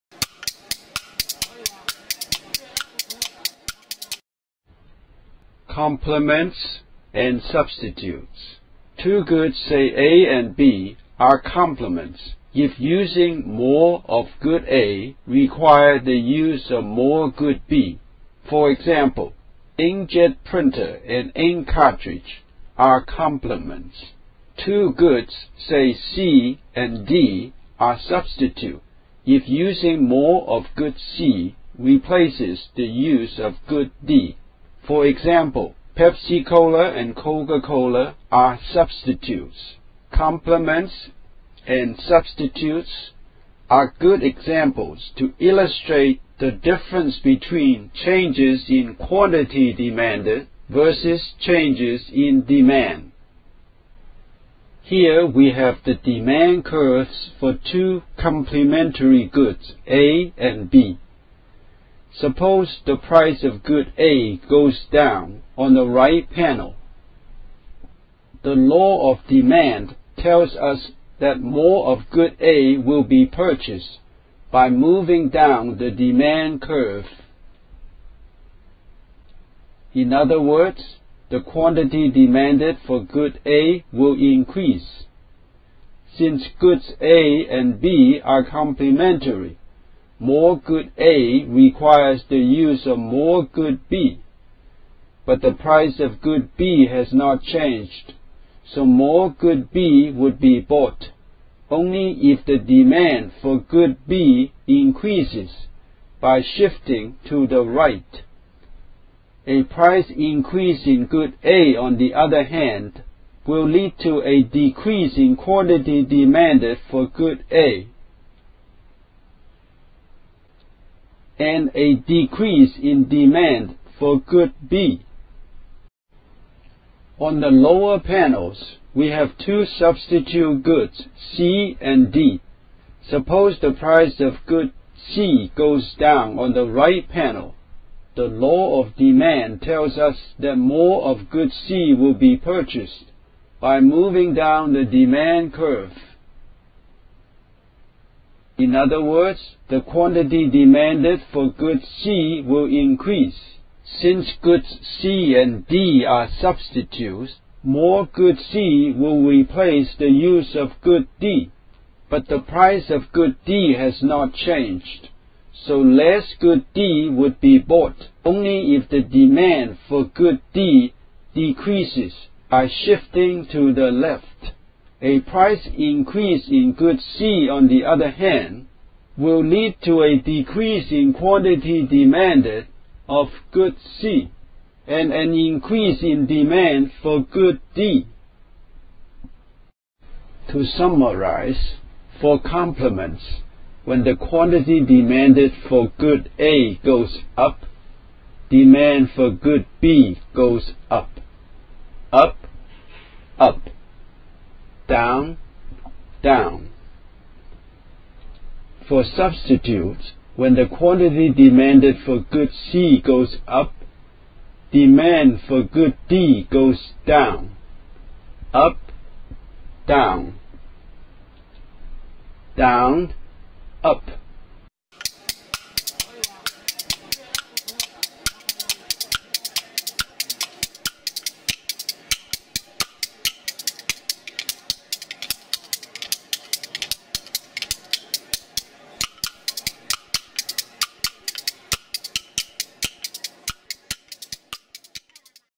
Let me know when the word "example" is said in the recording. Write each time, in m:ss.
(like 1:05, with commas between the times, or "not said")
0:18, 0:35, 0:44.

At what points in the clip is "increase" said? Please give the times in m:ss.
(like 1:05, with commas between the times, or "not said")
1:24, 1:44, 1:50, 2:32, 2:55, 3:05.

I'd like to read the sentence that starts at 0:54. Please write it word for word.
Here we have the demand curves for two complementary goods, A and B.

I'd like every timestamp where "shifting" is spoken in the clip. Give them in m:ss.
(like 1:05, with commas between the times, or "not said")
1:46, 2:52.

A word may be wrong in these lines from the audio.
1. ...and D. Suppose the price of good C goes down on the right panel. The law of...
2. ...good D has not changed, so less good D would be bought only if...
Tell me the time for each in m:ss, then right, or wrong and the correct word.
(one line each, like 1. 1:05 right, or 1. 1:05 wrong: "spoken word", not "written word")
1. 2:11 right
2. 2:43 right.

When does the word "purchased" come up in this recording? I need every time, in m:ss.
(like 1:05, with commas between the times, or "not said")
1:13, 2:22.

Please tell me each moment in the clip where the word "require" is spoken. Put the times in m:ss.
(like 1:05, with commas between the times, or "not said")
0:15, 1:31.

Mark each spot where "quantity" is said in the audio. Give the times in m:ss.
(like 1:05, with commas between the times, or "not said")
0:48, 1:21, 1:55, 2:29, 3:01, 3:14, 3:30.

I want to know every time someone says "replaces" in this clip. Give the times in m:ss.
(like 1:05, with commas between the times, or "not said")
0:31, 2:39.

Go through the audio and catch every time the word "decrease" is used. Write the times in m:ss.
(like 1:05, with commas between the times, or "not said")
1:54, 2:01, 2:51, 3:00.